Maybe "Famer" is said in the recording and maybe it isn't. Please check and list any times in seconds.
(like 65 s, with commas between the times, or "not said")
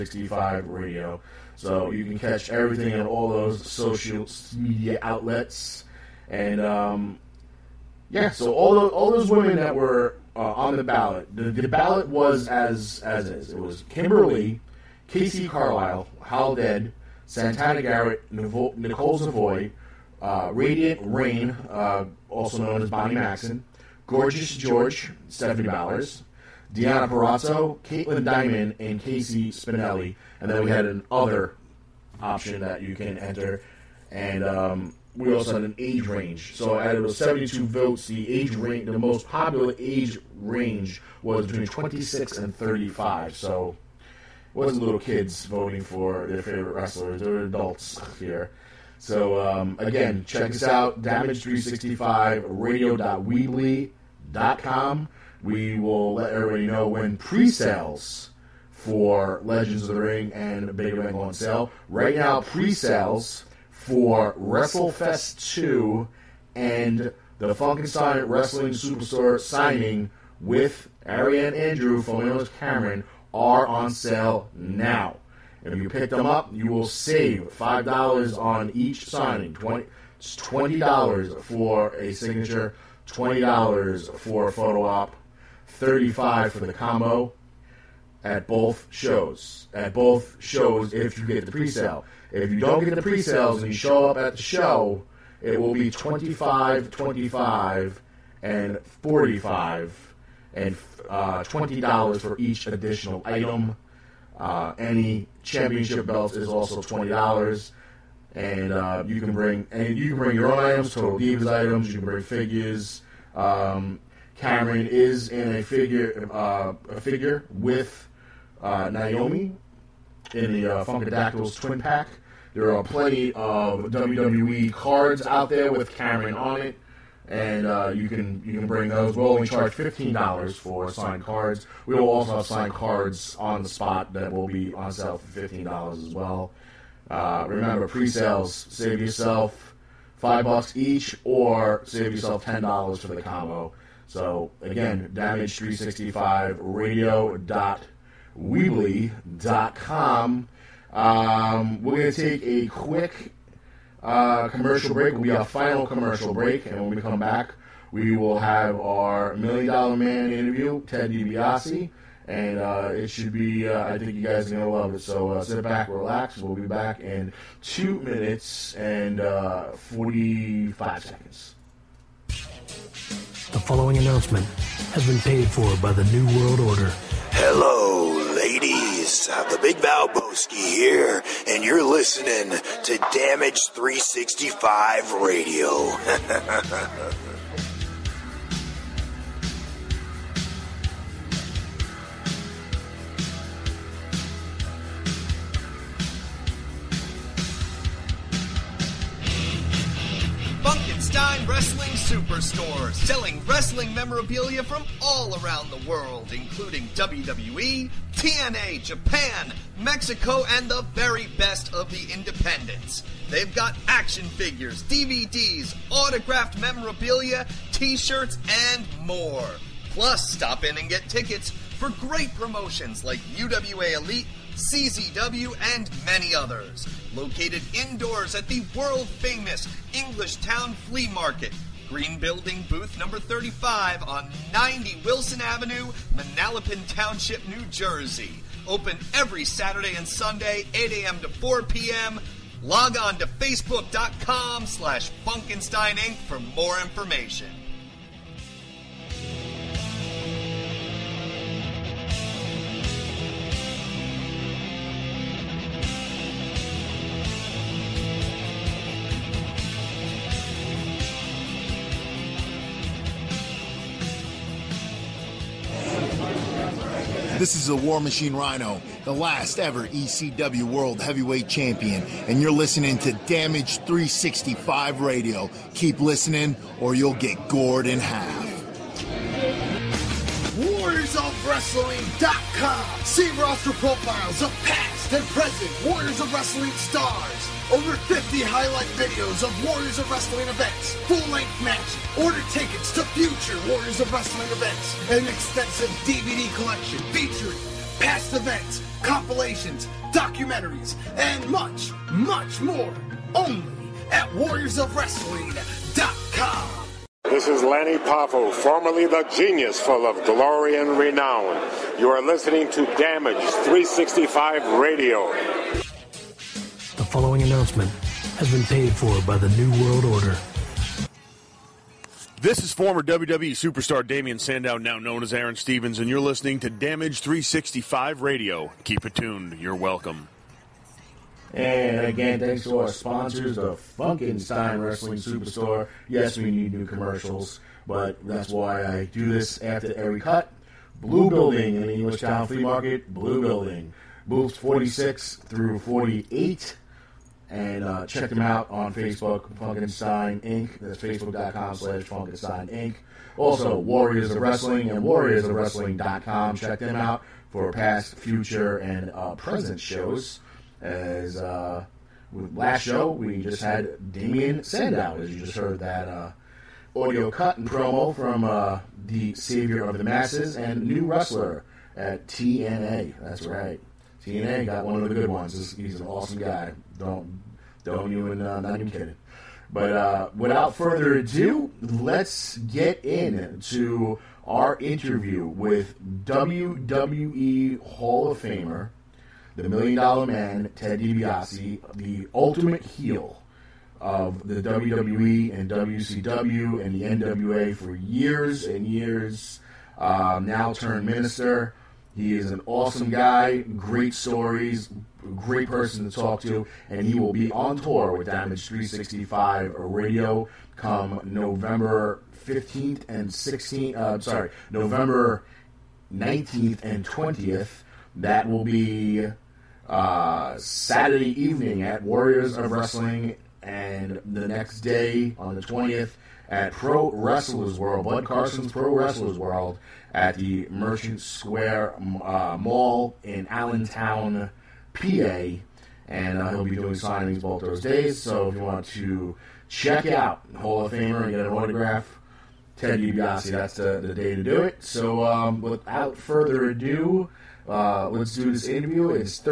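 388 s, 440 s.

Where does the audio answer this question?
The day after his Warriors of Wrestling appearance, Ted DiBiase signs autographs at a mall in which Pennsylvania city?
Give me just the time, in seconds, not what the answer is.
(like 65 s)
433 s.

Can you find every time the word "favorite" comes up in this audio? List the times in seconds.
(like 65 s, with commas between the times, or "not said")
46 s.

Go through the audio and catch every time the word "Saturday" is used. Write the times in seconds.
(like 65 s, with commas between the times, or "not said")
239 s, 420 s.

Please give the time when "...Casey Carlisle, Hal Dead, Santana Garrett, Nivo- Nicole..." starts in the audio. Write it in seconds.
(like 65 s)
15 s.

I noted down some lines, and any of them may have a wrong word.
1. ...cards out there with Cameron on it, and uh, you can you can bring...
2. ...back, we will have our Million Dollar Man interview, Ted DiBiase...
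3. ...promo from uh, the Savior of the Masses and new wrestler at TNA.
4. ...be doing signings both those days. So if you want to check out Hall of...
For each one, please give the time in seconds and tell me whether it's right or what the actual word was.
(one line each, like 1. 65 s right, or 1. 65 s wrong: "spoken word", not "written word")
1. 124 s right
2. 157 s right
3. 367 s right
4. 436 s right.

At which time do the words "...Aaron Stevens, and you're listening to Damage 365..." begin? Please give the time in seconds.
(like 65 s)
325 s.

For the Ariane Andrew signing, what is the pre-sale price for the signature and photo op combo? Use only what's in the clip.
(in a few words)
$35.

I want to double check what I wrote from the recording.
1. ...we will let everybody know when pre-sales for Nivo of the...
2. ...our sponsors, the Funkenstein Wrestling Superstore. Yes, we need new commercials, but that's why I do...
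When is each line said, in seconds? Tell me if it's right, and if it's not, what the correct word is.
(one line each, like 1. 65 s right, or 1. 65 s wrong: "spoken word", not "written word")
1. 55 s wrong: "Legends", not "Nivo"
2. 332 s right.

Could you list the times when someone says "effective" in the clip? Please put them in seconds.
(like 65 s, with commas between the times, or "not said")
not said.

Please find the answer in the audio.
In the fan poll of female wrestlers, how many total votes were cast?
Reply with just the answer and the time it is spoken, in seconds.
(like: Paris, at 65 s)
72, at 37 s.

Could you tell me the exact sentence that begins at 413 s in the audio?
Uh, sorry, November 19th and 20th.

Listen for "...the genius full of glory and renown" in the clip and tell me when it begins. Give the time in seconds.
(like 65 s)
309 s.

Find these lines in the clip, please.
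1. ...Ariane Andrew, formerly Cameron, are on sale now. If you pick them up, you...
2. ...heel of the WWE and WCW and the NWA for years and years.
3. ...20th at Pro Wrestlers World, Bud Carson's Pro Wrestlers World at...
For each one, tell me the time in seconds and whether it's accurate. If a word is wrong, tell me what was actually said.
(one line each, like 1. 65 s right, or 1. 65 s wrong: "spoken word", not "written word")
1. 71 s right
2. 392 s right
3. 425 s right.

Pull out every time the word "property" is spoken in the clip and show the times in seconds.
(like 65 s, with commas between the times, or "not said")
not said.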